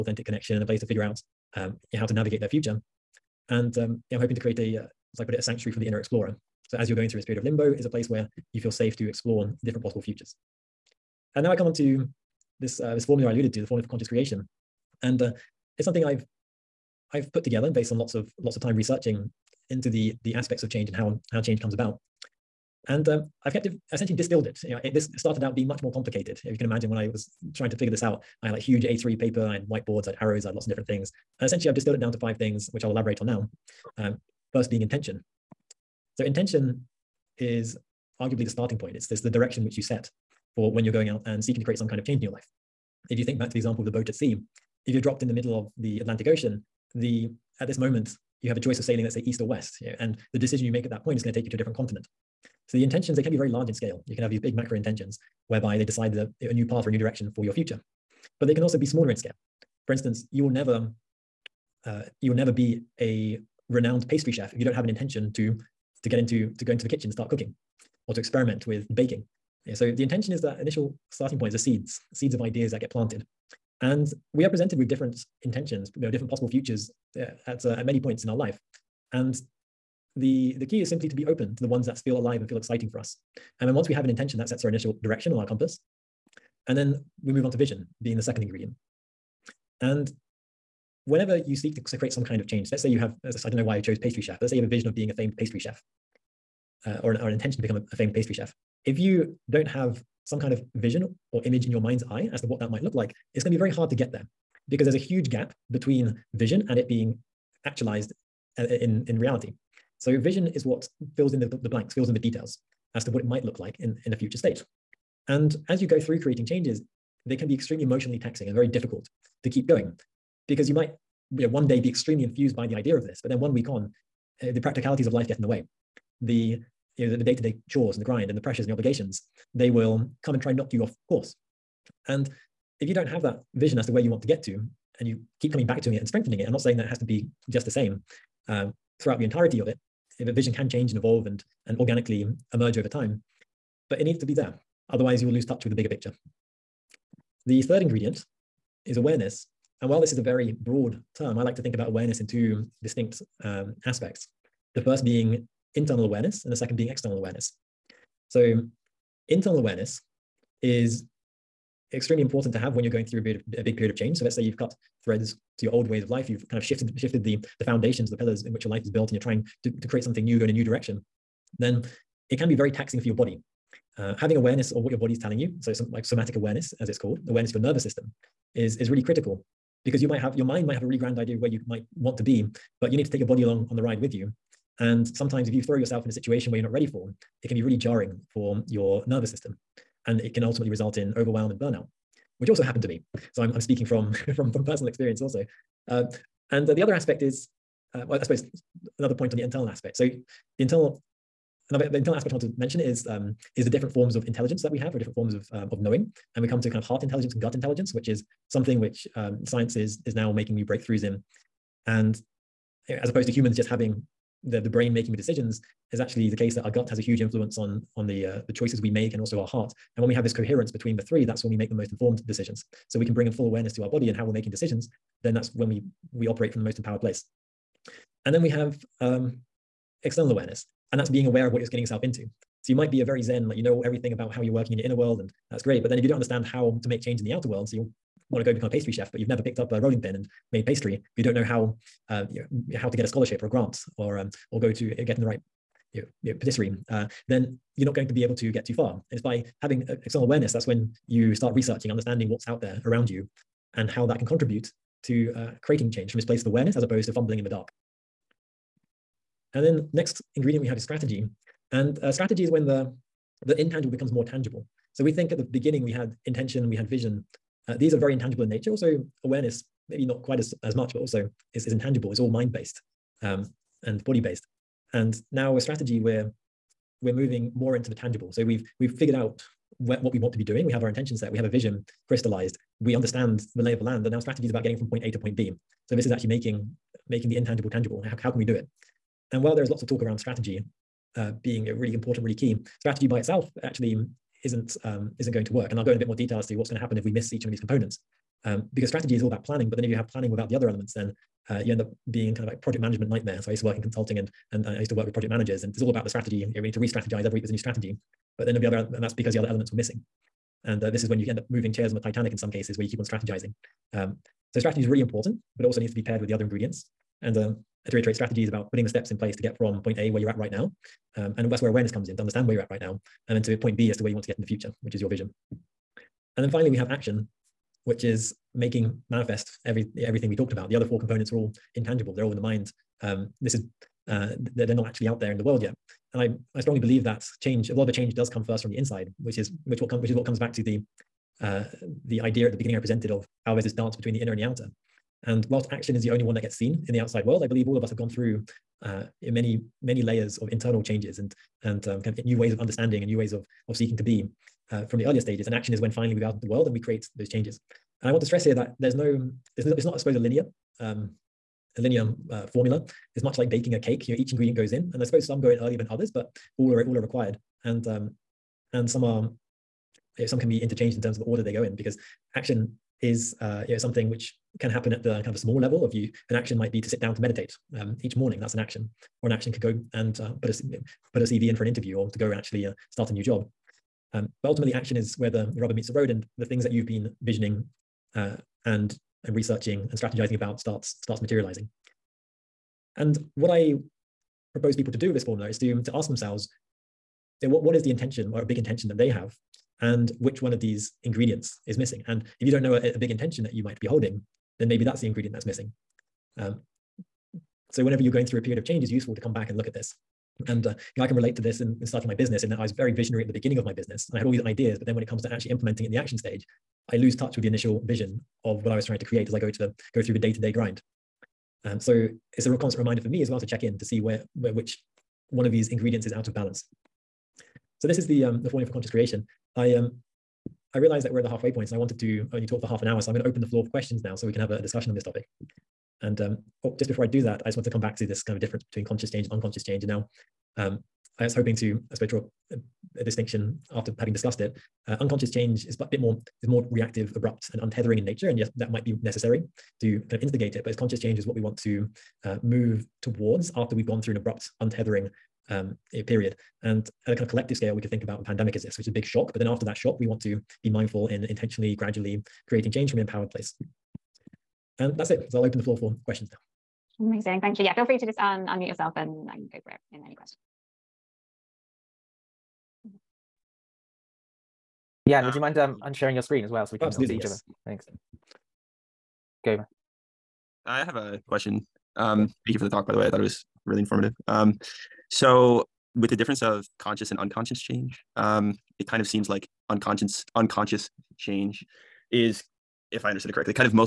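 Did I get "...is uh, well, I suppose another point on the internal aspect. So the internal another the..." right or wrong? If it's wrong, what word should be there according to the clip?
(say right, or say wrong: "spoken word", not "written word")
right.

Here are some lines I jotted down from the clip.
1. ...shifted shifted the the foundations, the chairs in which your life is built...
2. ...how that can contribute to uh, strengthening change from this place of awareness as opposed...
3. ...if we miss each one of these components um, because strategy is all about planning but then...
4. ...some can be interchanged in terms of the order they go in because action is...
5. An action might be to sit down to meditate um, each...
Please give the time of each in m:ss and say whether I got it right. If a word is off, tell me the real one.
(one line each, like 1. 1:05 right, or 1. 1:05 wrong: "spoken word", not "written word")
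1. 2:46 wrong: "pillars", not "chairs"
2. 4:13 wrong: "creating", not "strengthening"
3. 4:56 right
4. 6:10 right
5. 6:16 right.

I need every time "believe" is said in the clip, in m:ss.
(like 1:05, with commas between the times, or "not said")
5:36, 5:47.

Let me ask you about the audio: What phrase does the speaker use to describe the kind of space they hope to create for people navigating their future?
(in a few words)
A sanctuary for the inner explorer.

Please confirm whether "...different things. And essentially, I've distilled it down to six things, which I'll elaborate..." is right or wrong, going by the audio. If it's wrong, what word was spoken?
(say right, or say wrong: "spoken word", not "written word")
wrong: "five", not "six".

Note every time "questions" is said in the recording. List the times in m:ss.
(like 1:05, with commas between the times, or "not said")
7:13, 7:46, 7:50, 8:01.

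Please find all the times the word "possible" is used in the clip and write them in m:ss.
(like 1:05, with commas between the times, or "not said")
0:09, 1:16.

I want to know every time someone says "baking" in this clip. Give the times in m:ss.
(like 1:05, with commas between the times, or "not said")
1:08, 6:03.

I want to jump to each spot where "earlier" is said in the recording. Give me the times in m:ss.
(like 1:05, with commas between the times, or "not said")
5:55, 6:05.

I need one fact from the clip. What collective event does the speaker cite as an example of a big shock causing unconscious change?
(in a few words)
The pandemic.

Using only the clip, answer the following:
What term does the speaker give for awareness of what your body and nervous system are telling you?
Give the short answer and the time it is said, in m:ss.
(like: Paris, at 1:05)
Somatic awareness, at 2:56.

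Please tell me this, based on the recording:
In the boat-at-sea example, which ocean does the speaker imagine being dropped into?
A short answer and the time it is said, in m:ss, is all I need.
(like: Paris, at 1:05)
Atlantic Ocean, at 0:45.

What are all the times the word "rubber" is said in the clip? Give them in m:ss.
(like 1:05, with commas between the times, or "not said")
6:25.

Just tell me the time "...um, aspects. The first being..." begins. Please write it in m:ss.
2:33.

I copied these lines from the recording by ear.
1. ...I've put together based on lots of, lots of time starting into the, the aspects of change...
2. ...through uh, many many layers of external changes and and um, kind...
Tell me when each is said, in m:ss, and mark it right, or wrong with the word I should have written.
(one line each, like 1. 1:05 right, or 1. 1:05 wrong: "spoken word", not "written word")
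1. 0:17 wrong: "researching", not "starting"
2. 5:48 wrong: "internal", not "external".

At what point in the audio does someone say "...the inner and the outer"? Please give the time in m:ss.
5:44.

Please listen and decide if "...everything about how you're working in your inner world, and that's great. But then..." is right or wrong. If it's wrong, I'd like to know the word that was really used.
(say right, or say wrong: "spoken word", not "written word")
right.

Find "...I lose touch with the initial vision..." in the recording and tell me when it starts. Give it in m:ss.
6:56.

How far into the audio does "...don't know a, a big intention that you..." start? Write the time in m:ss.
6:42.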